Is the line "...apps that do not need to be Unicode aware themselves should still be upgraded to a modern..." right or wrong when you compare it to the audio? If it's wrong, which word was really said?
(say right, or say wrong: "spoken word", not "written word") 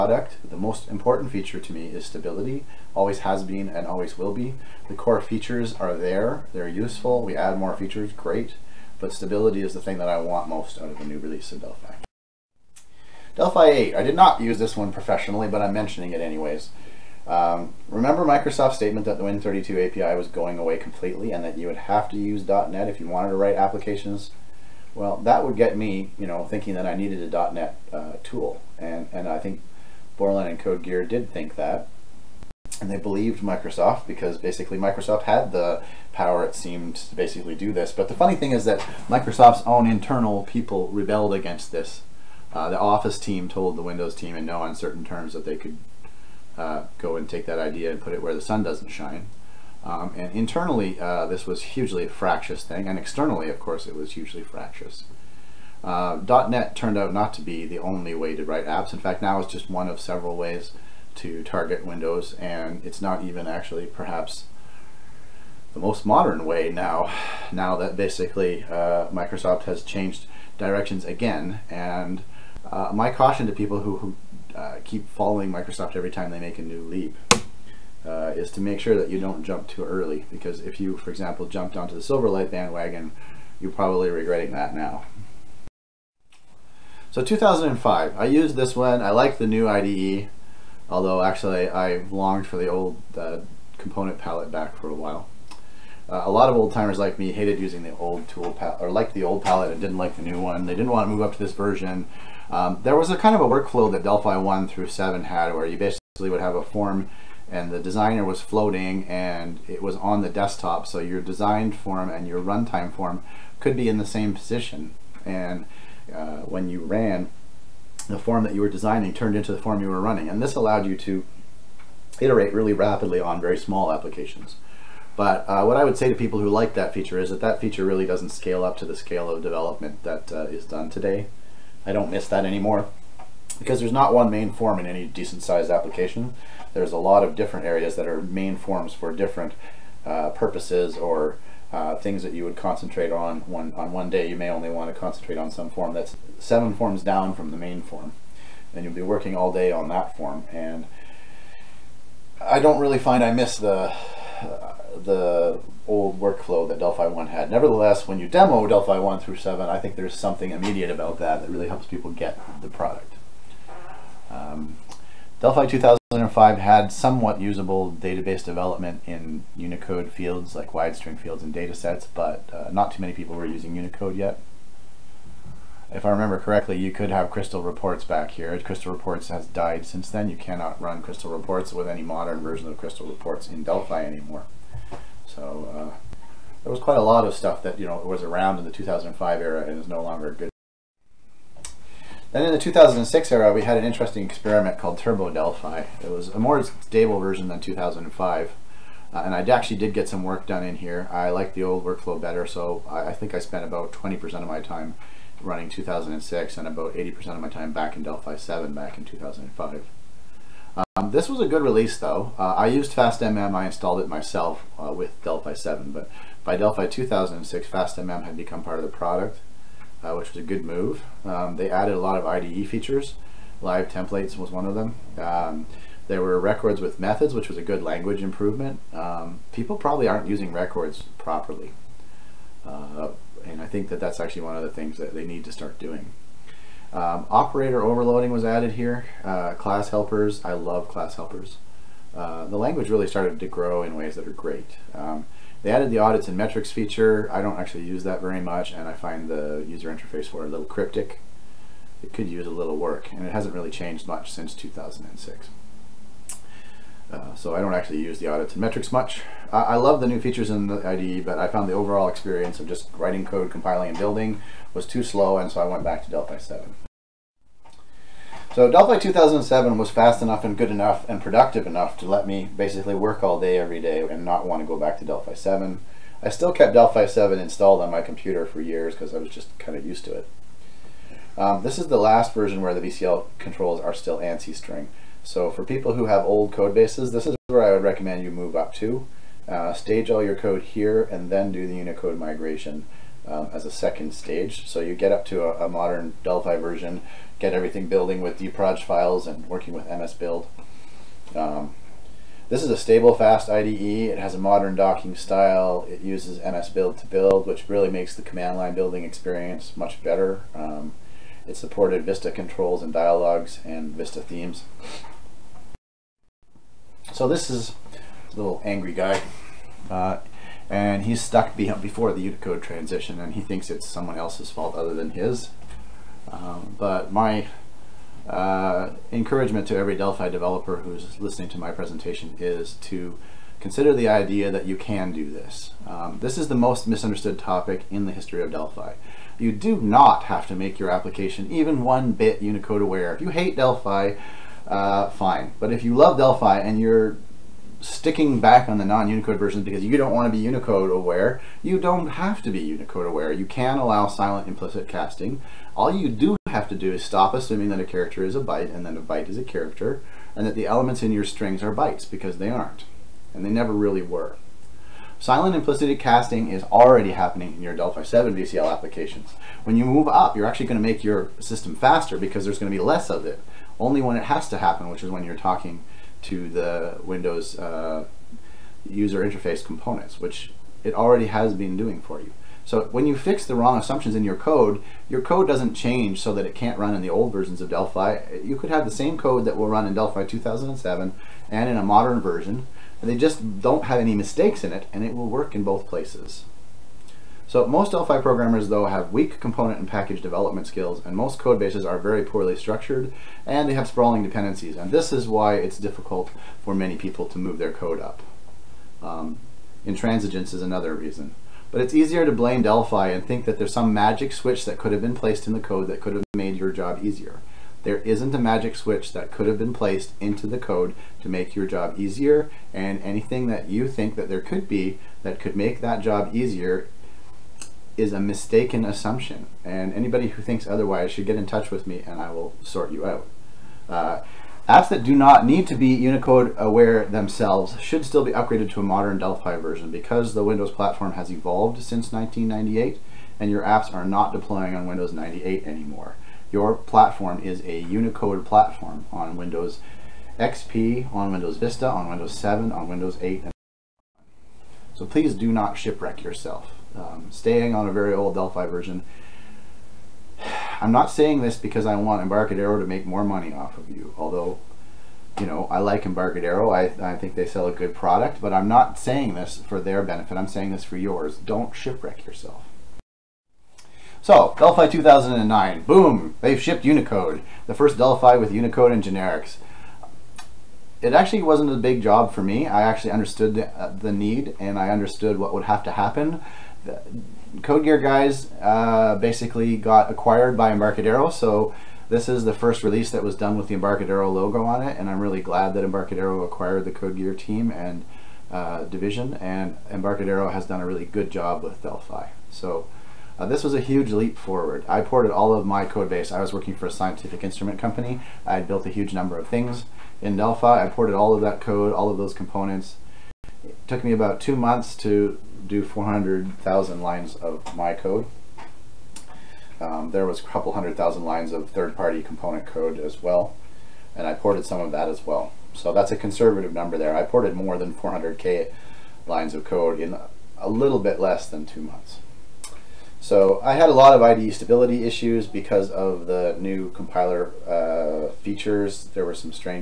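right.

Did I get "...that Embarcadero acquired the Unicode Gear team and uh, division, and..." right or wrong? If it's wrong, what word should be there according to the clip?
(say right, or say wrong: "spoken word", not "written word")
wrong: "Code", not "Unicode".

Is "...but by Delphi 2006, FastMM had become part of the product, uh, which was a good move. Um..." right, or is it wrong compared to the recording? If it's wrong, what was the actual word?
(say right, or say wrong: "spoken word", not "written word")
right.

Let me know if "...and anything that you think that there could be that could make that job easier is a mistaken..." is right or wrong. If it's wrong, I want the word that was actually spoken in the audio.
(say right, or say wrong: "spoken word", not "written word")
right.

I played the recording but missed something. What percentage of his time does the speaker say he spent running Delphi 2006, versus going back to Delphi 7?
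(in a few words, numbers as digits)
20%.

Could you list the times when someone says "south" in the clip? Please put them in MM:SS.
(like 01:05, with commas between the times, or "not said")
not said.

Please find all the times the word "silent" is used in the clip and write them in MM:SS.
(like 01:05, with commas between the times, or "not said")
05:54, 06:05.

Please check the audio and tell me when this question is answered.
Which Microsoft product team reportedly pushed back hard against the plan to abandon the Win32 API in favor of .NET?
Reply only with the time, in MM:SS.
00:42.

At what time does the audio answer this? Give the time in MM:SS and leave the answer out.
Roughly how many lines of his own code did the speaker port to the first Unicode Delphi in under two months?
08:35.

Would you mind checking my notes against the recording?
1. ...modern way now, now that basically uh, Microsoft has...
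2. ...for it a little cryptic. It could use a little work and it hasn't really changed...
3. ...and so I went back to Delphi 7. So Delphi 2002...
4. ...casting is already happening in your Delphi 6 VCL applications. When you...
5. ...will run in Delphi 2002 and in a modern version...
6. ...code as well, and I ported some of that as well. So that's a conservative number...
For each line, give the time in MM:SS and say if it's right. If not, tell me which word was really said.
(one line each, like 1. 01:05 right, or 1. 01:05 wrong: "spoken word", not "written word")
1. 01:06 right
2. 04:10 right
3. 04:25 wrong: "2007", not "2002"
4. 06:05 wrong: "7", not "6"
5. 06:29 wrong: "2007", not "2002"
6. 08:42 right.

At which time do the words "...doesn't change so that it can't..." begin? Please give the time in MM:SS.
06:25.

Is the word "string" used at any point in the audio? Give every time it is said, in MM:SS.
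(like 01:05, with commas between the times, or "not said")
02:50, 04:44, 06:01.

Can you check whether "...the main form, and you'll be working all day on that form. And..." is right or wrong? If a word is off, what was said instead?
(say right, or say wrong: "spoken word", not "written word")
right.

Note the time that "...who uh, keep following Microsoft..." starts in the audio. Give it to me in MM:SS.
01:13.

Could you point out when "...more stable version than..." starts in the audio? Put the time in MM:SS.
03:16.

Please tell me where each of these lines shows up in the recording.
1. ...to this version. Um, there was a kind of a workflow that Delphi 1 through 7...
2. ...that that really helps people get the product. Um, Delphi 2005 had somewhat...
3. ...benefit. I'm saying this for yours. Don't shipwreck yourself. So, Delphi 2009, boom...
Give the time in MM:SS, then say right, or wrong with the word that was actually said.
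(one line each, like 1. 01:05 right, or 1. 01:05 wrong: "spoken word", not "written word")
1. 01:41 right
2. 02:41 right
3. 07:50 right.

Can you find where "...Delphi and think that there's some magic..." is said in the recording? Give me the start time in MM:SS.
06:52.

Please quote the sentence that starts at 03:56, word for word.
Um, operator overloading was added here.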